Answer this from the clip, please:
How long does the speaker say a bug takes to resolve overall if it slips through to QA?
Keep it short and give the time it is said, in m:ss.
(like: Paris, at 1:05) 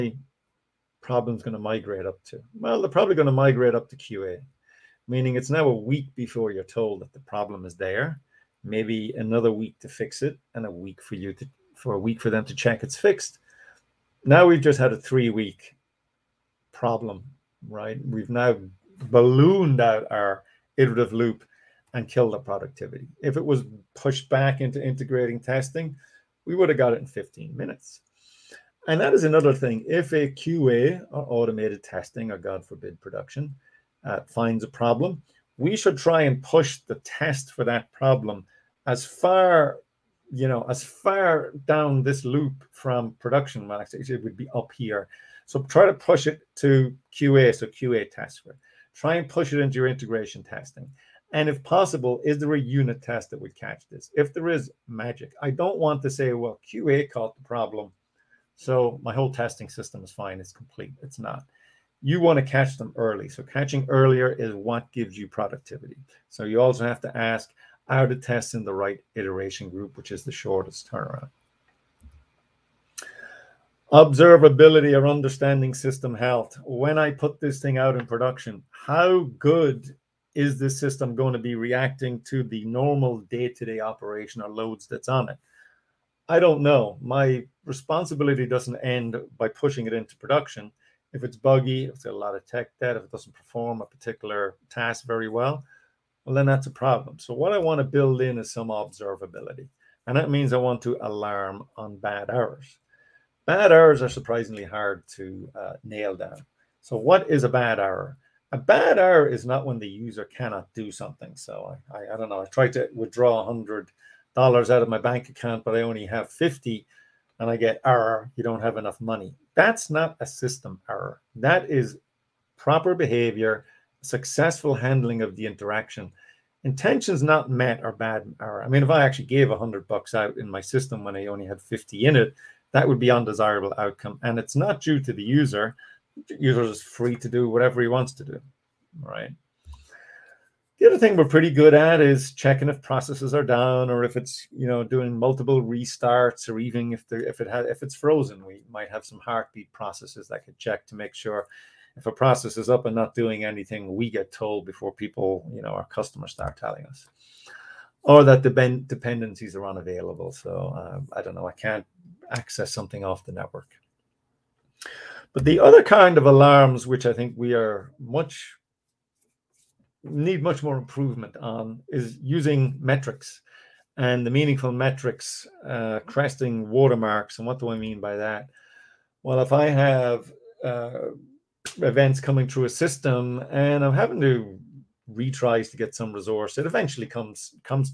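3 weeks, at 0:14.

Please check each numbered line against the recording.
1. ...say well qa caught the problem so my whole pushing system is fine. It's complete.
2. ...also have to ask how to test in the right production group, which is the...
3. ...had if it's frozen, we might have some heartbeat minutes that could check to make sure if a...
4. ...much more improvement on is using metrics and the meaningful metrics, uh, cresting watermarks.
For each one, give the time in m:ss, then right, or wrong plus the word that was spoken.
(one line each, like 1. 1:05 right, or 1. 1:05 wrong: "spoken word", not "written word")
1. 0:56 wrong: "testing", not "pushing"
2. 1:06 wrong: "iteration", not "production"
3. 2:27 wrong: "processes", not "minutes"
4. 2:50 right.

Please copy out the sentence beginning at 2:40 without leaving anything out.
So um, I don't know, I can't access something off the network.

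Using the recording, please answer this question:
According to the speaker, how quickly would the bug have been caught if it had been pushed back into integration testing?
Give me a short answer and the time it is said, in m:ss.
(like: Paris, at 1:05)
15 minutes, at 0:27.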